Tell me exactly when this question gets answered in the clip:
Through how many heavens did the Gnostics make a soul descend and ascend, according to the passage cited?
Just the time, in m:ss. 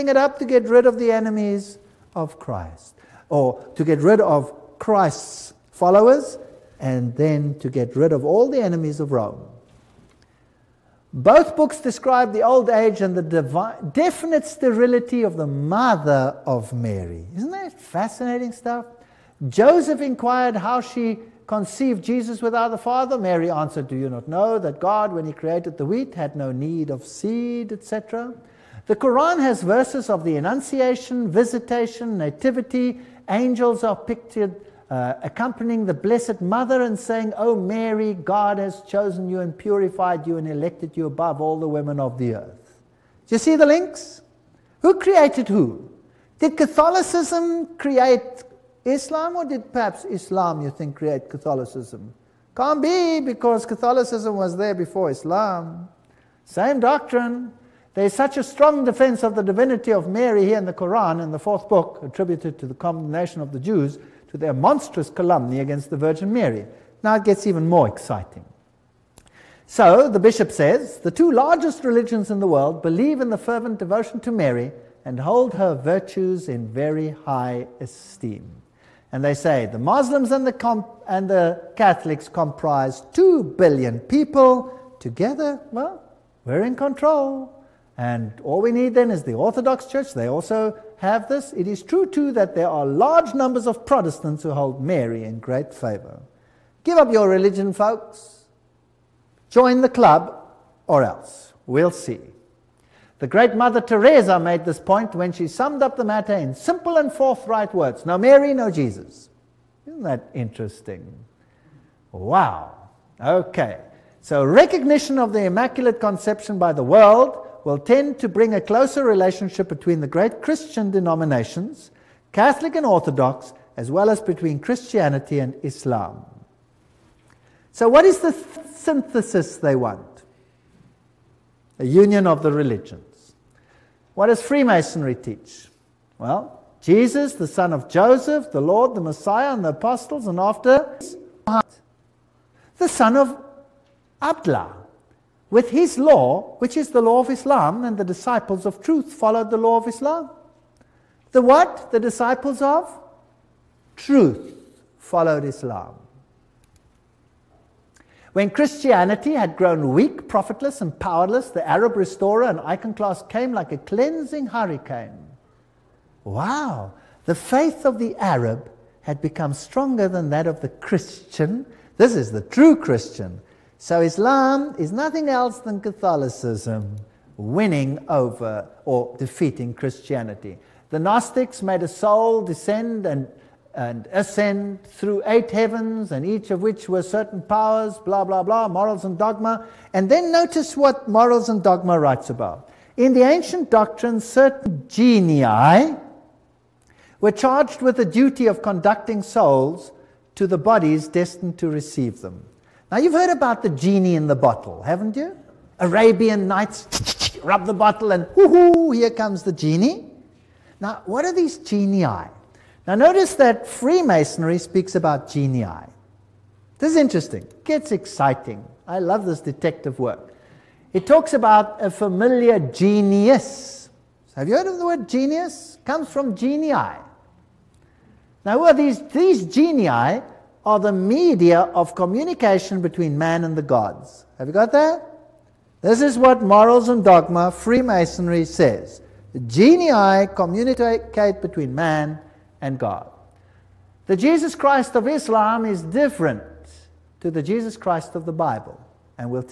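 3:05.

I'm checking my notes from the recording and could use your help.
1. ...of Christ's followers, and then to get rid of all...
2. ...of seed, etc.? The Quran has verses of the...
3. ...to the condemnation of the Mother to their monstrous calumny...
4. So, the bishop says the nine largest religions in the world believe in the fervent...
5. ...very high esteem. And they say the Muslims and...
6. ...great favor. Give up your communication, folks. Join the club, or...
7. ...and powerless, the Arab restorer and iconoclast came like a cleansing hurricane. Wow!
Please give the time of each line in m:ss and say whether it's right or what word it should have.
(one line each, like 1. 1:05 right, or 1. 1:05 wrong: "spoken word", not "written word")
1. 0:04 right
2. 0:26 right
3. 1:02 wrong: "Jews", not "Mother"
4. 1:09 wrong: "two", not "nine"
5. 1:16 right
6. 1:35 wrong: "religion", not "communication"
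7. 2:40 right.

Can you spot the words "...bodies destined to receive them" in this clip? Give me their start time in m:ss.
3:20.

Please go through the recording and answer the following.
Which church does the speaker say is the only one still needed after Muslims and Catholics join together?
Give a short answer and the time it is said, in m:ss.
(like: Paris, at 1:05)
Orthodox Church, at 1:29.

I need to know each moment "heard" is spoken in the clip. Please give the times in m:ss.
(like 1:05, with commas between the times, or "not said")
3:23, 3:44.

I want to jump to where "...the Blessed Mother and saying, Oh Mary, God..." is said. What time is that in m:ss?
0:35.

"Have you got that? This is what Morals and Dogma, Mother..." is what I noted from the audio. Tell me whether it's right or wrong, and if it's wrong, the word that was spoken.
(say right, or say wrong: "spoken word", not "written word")
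wrong: "Freemasonry", not "Mother".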